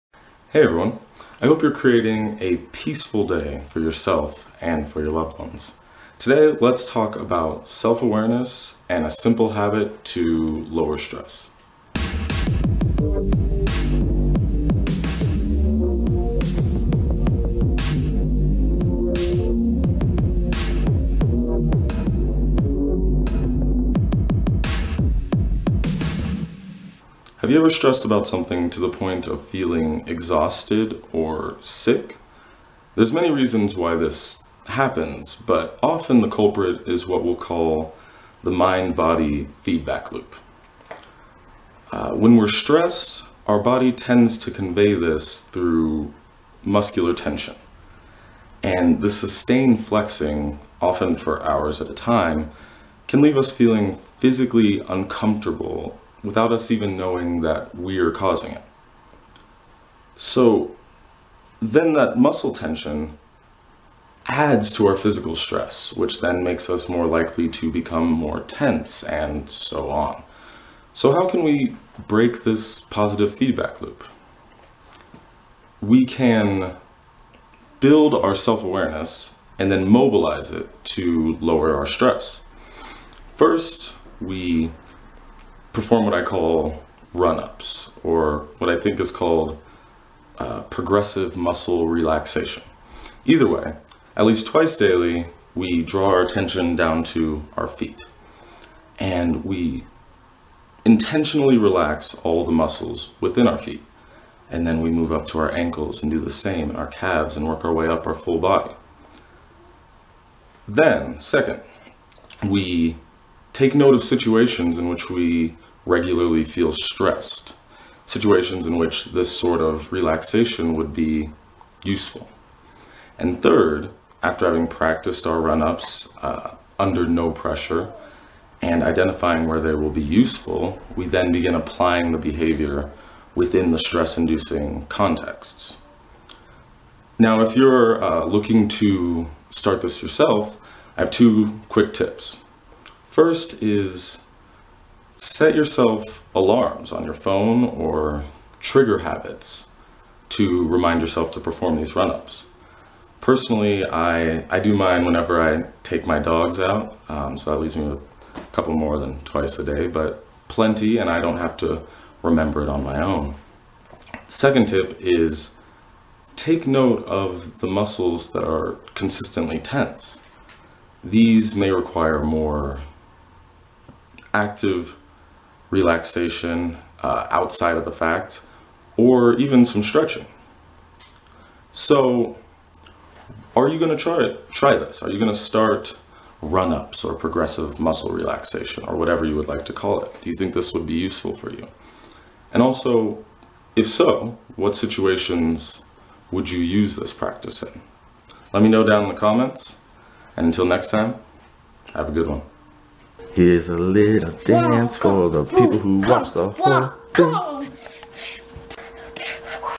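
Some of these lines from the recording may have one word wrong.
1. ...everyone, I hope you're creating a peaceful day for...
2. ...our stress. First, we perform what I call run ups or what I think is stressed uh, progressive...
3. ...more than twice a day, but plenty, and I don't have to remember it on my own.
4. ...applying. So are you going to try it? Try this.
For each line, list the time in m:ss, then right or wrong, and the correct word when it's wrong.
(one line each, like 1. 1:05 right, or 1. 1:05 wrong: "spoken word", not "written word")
1. 0:00 right
2. 1:21 wrong: "called", not "stressed"
3. 2:38 right
4. 2:59 wrong: "stretching", not "applying".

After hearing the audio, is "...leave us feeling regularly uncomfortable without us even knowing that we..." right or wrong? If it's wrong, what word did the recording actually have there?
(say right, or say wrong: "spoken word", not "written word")
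wrong: "physically", not "regularly".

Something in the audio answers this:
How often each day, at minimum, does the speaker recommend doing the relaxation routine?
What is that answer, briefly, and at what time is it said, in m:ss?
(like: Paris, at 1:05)
twice daily, at 1:34.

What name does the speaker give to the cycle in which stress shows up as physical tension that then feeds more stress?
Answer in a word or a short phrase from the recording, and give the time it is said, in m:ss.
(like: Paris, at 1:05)
mind-body feedback loop, at 0:38.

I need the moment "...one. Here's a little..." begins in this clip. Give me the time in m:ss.
3:22.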